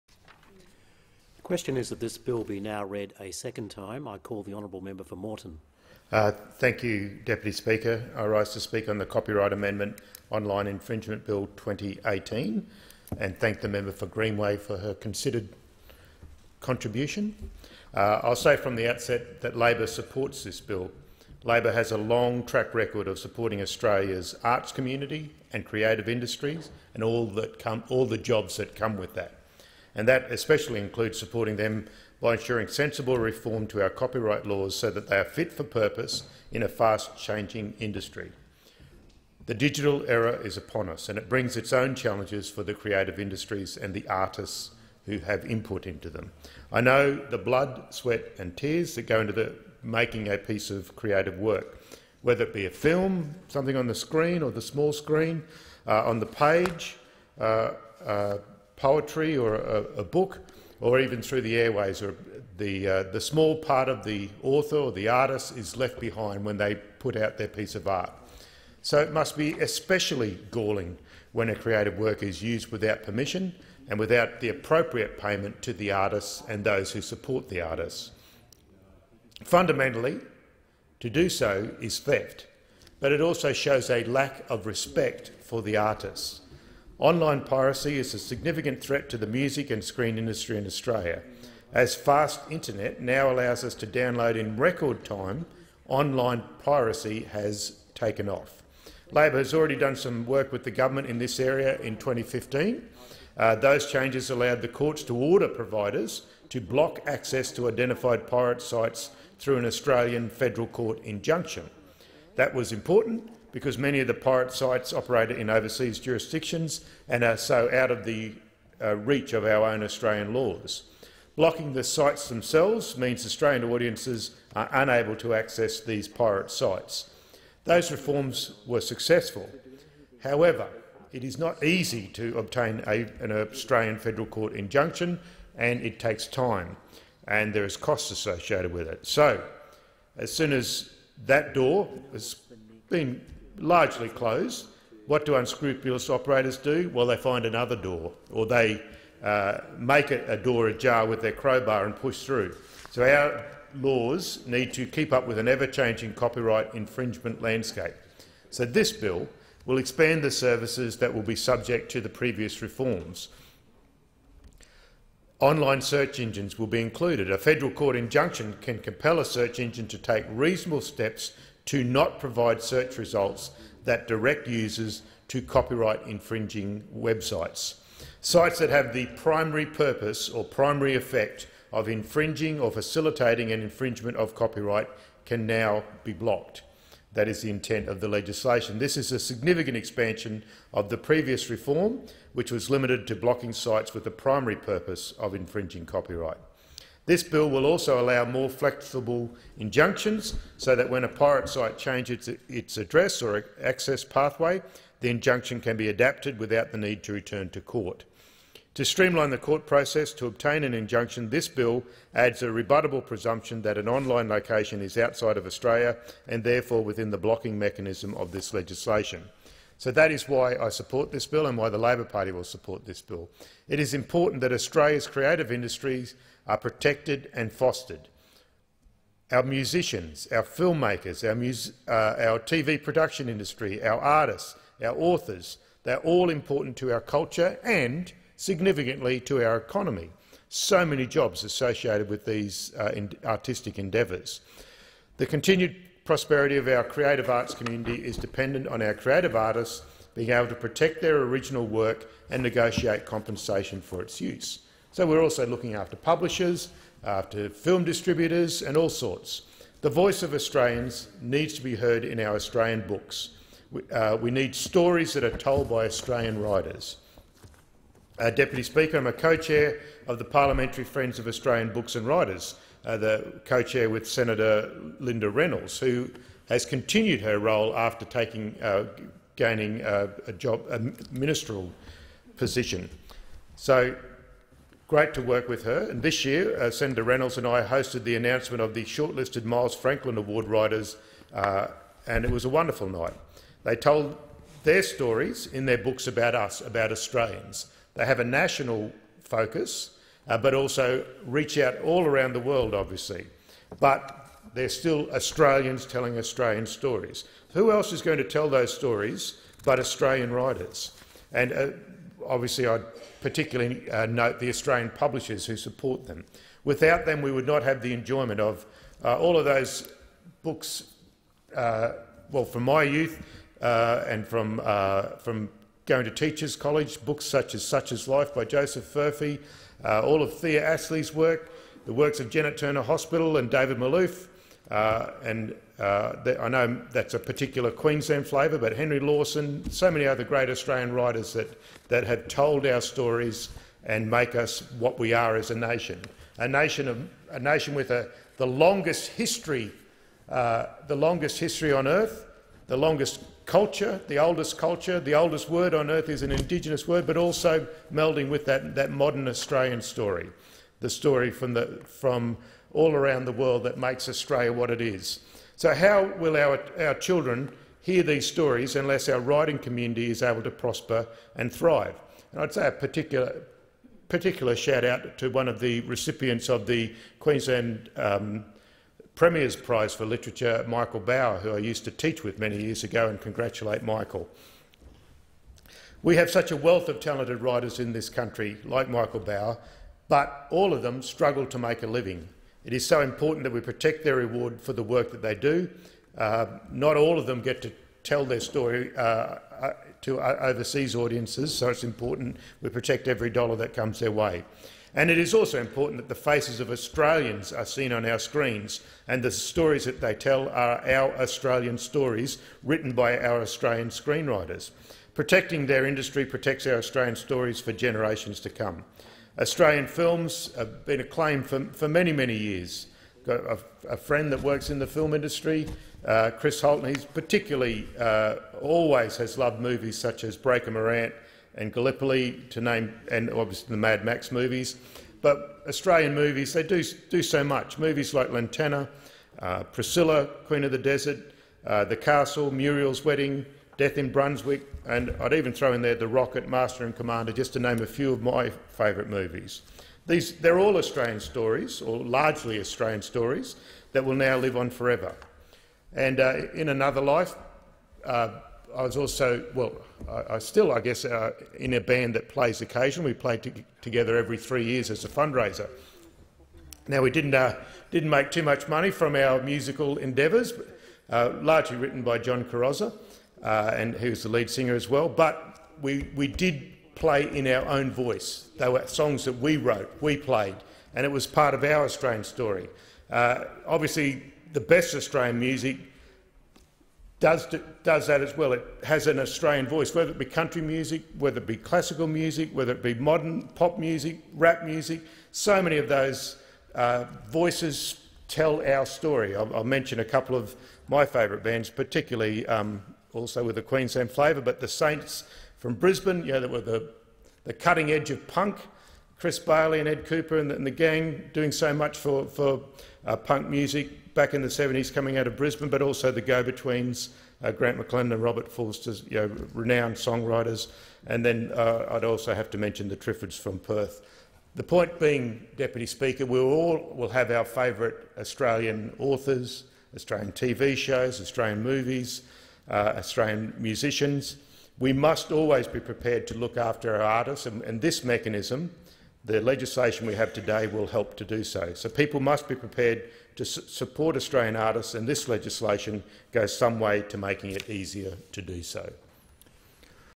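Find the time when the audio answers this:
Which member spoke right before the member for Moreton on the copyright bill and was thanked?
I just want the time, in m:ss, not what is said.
0:13.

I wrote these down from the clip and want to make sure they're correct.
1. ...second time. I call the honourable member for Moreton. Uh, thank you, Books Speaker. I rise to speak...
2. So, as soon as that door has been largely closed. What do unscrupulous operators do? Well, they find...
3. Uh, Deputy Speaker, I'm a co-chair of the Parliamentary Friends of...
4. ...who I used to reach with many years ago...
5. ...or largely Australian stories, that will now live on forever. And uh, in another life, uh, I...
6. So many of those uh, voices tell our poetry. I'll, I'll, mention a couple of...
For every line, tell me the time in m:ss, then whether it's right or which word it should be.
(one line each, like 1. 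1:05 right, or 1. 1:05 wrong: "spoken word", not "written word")
1. 0:03 wrong: "Deputy", not "Books"
2. 2:19 right
3. 4:28 right
4. 6:21 wrong: "teach", not "reach"
5. 7:31 right
6. 8:15 wrong: "story", not "poetry".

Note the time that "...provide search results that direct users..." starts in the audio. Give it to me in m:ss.
2:52.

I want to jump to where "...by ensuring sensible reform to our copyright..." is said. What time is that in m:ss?
0:32.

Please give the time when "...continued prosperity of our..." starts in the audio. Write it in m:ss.
4:05.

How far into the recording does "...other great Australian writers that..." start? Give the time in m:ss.
5:40.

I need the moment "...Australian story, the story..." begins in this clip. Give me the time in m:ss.
5:59.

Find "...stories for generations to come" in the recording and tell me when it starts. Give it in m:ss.
6:57.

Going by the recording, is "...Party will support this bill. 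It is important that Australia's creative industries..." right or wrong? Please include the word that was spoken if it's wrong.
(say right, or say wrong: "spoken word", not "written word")
right.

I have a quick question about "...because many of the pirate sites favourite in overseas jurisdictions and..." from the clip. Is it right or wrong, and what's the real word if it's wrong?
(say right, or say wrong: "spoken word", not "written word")
wrong: "operate", not "favourite".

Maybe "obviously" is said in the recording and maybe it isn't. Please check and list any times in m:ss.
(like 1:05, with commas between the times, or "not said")
5:02, 5:12, 7:13, 8:03.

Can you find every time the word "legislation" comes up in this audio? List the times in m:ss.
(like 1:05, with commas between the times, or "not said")
3:08, 3:38, 8:59, 9:05.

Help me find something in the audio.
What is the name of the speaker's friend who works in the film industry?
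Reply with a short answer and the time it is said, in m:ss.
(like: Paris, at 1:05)
Chris Holton, at 7:06.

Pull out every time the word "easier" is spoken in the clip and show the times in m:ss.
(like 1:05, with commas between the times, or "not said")
9:07.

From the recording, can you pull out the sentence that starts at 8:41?
And then uh, I'd also have to mention the Triffids from Perth.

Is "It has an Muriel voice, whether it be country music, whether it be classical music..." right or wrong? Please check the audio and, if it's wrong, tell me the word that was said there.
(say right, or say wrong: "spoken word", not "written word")
wrong: "Australian", not "Muriel".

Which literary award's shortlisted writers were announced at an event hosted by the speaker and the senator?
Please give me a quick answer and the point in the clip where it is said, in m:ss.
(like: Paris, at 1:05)
Miles Franklin Award, at 4:49.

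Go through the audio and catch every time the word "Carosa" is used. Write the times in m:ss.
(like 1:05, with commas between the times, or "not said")
7:52.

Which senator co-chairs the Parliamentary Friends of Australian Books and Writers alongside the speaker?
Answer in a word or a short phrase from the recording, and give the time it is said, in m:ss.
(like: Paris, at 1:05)
Linda Reynolds, at 4:34.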